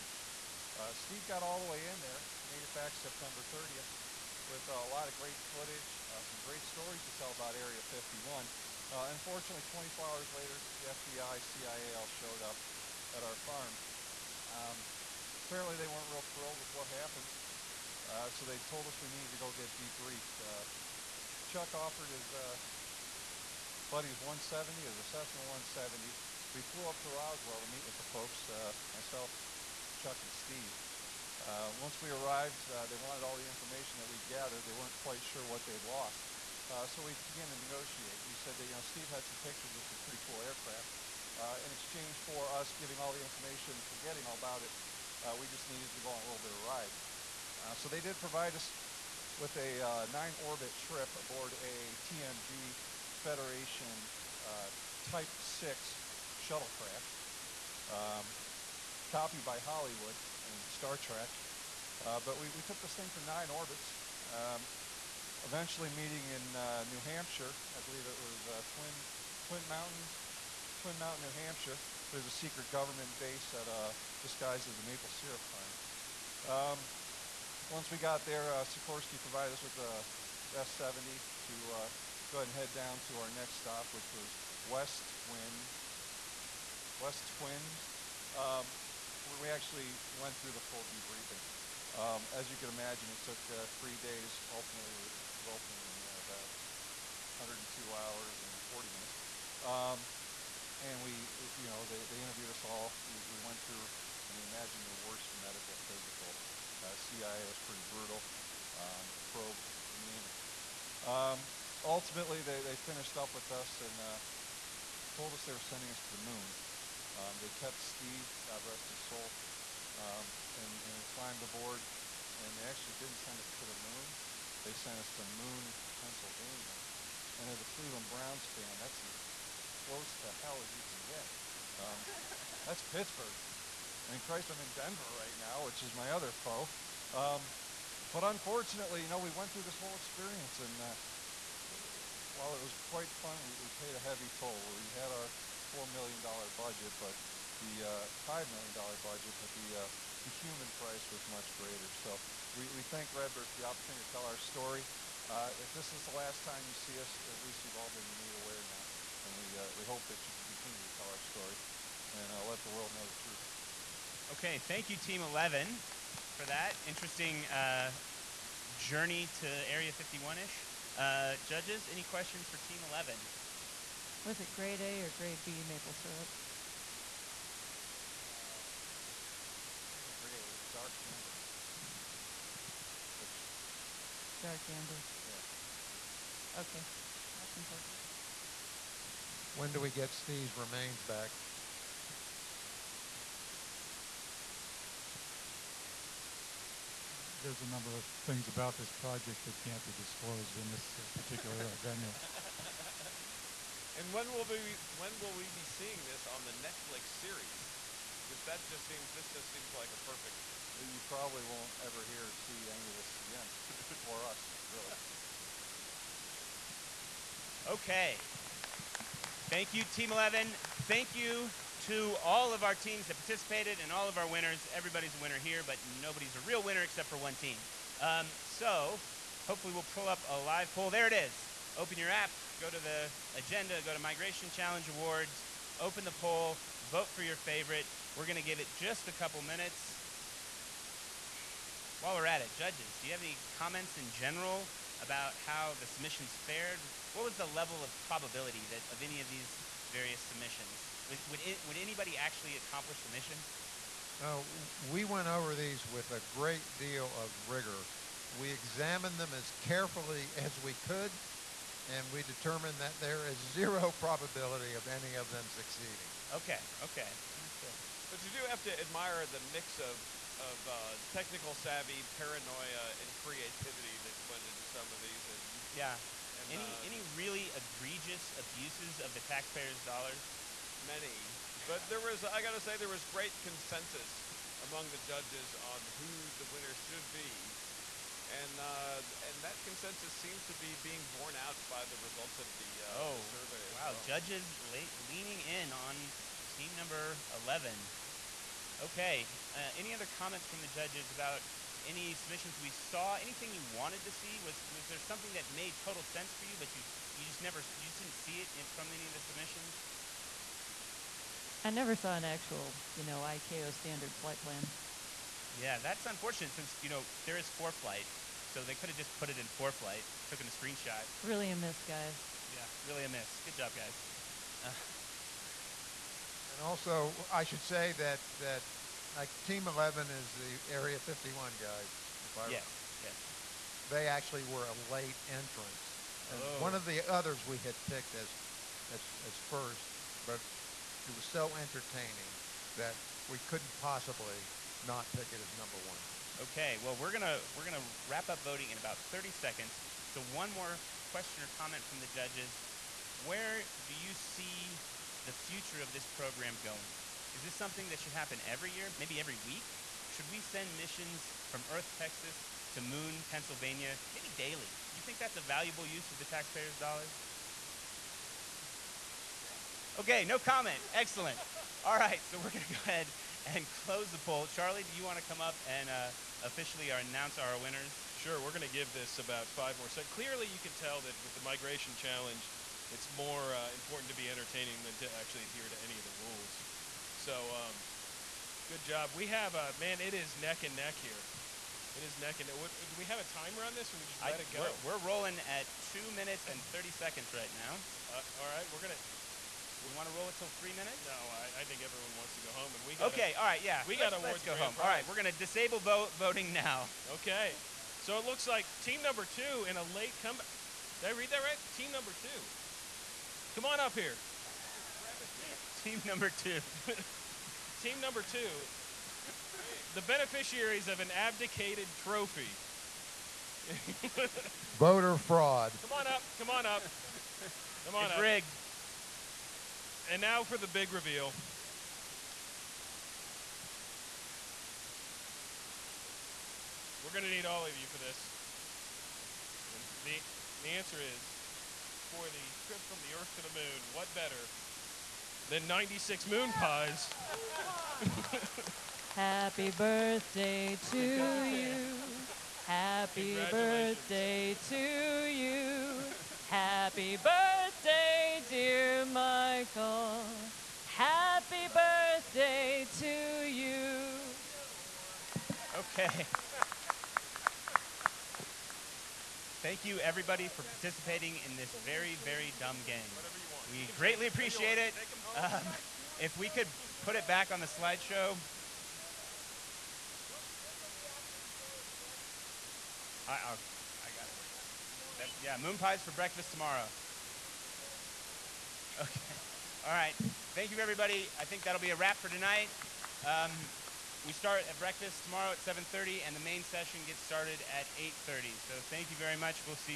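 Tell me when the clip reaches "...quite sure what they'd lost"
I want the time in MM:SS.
00:34.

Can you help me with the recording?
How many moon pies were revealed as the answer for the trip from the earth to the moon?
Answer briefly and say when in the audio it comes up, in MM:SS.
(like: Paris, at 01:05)
96, at 07:25.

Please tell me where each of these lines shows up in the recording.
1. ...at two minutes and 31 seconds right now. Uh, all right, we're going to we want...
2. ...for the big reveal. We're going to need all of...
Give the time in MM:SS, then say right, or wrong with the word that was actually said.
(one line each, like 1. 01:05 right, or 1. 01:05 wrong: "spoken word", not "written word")
1. 06:35 wrong: "30", not "31"
2. 07:10 right.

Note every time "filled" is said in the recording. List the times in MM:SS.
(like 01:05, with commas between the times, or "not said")
not said.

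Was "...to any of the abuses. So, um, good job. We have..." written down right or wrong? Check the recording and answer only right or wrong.
wrong.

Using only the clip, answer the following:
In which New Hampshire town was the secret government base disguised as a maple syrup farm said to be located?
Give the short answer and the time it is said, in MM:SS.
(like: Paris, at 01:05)
Twin Mountain, at 01:10.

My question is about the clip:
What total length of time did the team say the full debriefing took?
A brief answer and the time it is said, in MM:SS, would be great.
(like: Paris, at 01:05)
102 hours and 40 minutes, at 01:36.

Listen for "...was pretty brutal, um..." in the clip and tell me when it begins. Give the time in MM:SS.
01:47.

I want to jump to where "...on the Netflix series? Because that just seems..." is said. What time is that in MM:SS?
03:26.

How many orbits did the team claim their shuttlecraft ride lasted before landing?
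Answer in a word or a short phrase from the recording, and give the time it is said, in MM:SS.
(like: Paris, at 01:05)
9, at 00:50.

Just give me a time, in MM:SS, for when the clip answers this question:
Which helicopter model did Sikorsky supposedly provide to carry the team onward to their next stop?
01:19.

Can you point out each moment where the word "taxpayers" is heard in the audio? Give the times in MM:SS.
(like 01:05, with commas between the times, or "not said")
04:39, 06:06.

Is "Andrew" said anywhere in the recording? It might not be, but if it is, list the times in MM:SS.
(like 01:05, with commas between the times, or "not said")
not said.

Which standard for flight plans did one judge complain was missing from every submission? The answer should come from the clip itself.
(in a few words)
ICAO standard.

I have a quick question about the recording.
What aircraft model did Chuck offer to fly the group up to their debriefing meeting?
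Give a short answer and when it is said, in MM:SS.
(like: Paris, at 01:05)
Cessna 170, at 00:24.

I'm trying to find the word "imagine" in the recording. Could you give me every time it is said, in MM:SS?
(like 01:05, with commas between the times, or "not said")
01:32, 01:44.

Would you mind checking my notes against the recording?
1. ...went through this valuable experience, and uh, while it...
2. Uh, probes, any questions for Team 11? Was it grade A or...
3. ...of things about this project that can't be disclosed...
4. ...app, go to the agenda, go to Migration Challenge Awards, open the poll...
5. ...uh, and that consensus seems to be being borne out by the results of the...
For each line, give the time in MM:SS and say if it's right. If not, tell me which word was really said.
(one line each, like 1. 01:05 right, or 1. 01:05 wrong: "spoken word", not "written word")
1. 02:19 wrong: "whole", not "valuable"
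2. 02:50 wrong: "judges", not "probes"
3. 03:17 right
4. 03:52 right
5. 04:48 right.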